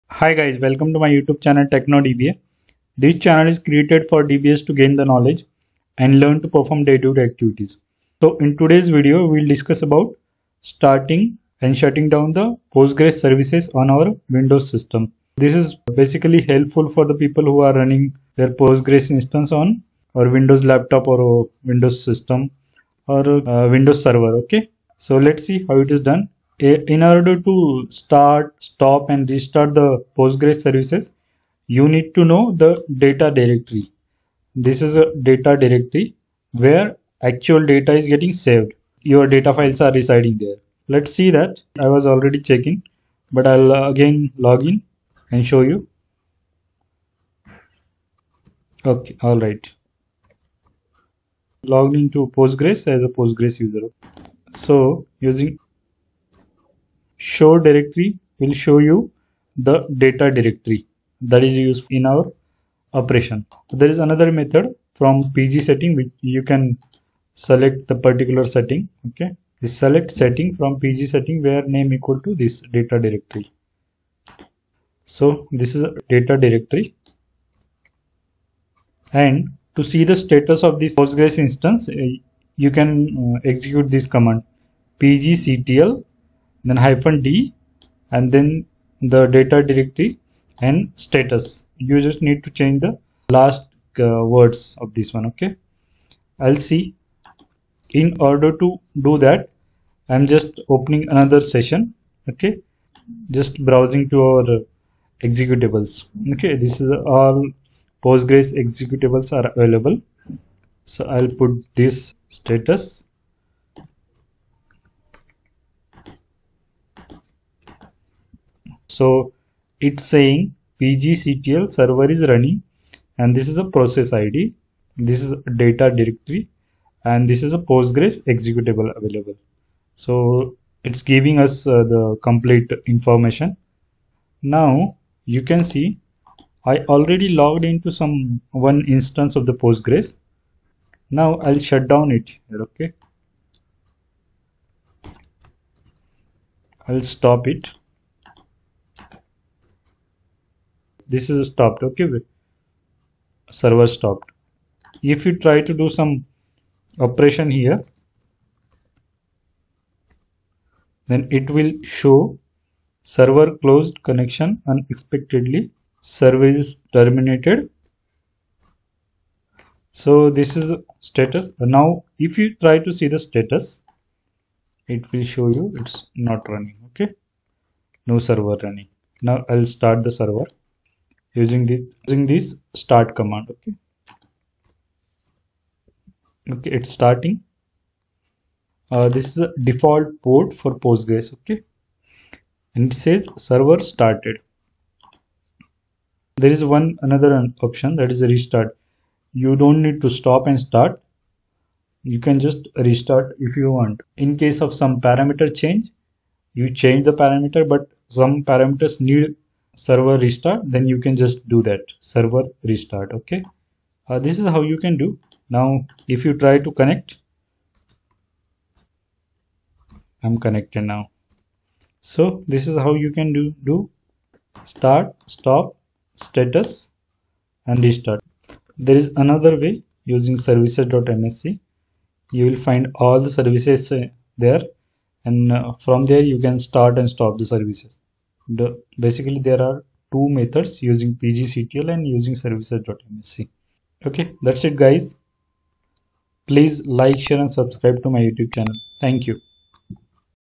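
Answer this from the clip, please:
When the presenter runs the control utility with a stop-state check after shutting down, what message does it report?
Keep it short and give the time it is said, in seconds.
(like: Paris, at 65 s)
no server running, at 178 s.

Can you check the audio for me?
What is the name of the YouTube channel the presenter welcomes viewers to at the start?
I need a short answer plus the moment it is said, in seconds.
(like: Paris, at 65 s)
TechnoDBA, at 1 s.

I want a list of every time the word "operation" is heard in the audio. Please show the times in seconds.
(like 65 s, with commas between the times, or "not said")
63 s, 157 s.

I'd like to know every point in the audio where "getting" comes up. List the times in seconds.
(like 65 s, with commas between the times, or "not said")
38 s.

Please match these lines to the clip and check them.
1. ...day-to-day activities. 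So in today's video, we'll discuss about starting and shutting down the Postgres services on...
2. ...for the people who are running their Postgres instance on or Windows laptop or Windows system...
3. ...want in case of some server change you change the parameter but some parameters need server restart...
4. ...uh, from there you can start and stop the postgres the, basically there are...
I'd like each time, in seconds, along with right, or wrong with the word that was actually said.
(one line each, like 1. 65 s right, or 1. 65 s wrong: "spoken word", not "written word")
1. 6 s right
2. 16 s right
3. 203 s wrong: "parameter", not "server"
4. 235 s wrong: "services", not "postgres".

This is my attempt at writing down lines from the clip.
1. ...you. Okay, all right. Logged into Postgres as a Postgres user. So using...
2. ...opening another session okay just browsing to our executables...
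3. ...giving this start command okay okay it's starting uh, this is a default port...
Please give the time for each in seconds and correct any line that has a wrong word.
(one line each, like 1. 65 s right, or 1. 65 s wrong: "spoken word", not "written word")
1. 45 s right
2. 100 s right
3. 182 s wrong: "using", not "giving".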